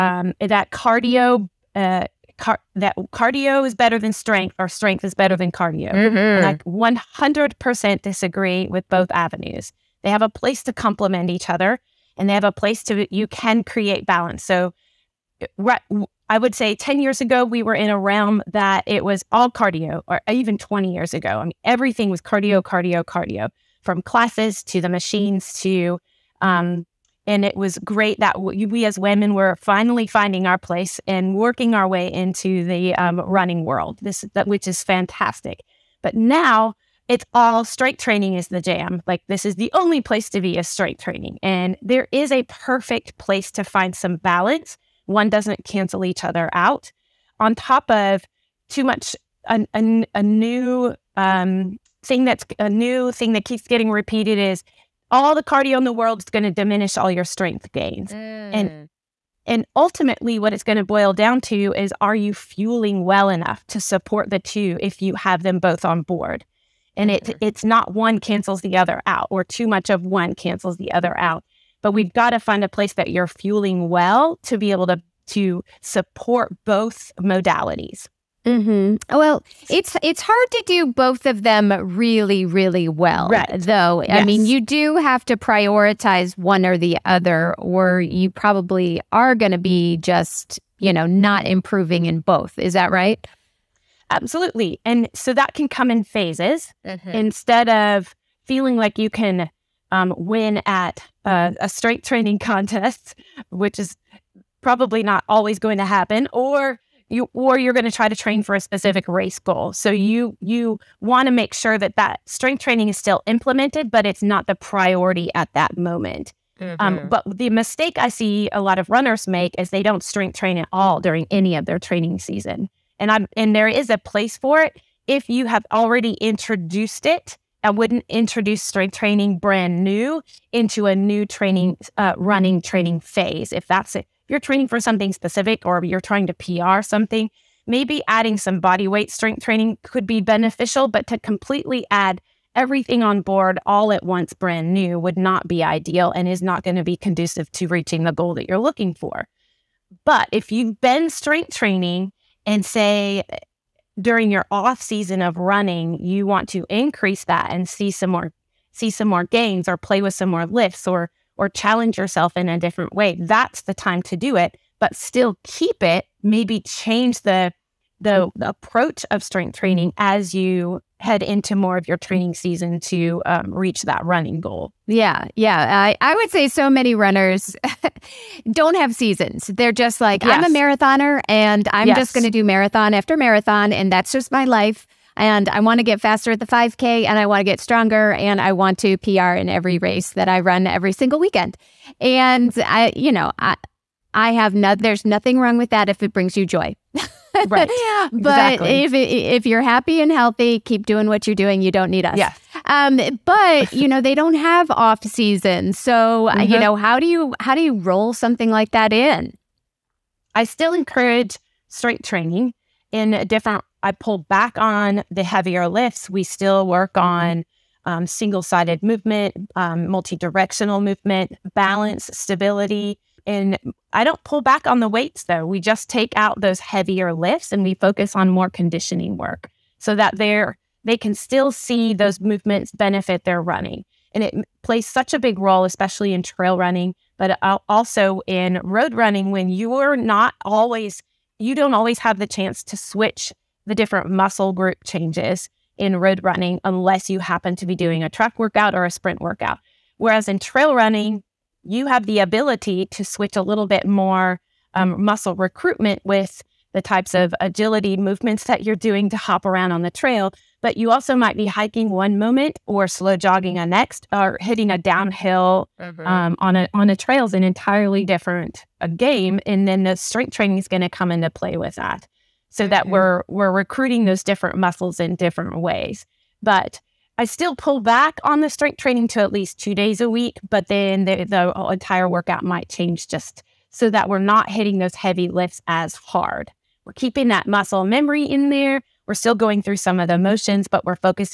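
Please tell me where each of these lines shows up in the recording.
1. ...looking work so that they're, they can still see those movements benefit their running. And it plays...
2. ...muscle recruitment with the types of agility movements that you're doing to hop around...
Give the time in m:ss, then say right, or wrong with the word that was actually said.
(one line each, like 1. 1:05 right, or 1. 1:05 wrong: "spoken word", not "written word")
1. 3:48 wrong: "conditioning", not "looking"
2. 4:15 right.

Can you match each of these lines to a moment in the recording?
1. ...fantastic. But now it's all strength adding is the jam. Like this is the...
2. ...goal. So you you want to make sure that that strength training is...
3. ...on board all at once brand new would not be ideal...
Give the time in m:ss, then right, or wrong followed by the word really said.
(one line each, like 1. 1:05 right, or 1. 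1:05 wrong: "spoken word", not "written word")
1. 0:34 wrong: "training", not "adding"
2. 1:49 right
3. 2:23 right.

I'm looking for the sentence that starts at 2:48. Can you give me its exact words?
approach of strength training as you head into more of your training season to um, reach that running goal.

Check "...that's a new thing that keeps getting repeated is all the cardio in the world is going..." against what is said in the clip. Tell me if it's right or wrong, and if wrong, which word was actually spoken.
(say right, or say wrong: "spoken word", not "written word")
right.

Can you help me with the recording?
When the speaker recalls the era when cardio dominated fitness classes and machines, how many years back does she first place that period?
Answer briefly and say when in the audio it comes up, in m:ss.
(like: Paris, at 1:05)
10, at 0:16.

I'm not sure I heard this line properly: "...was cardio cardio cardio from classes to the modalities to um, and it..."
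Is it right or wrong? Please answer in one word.
wrong.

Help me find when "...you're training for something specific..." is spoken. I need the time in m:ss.
2:14.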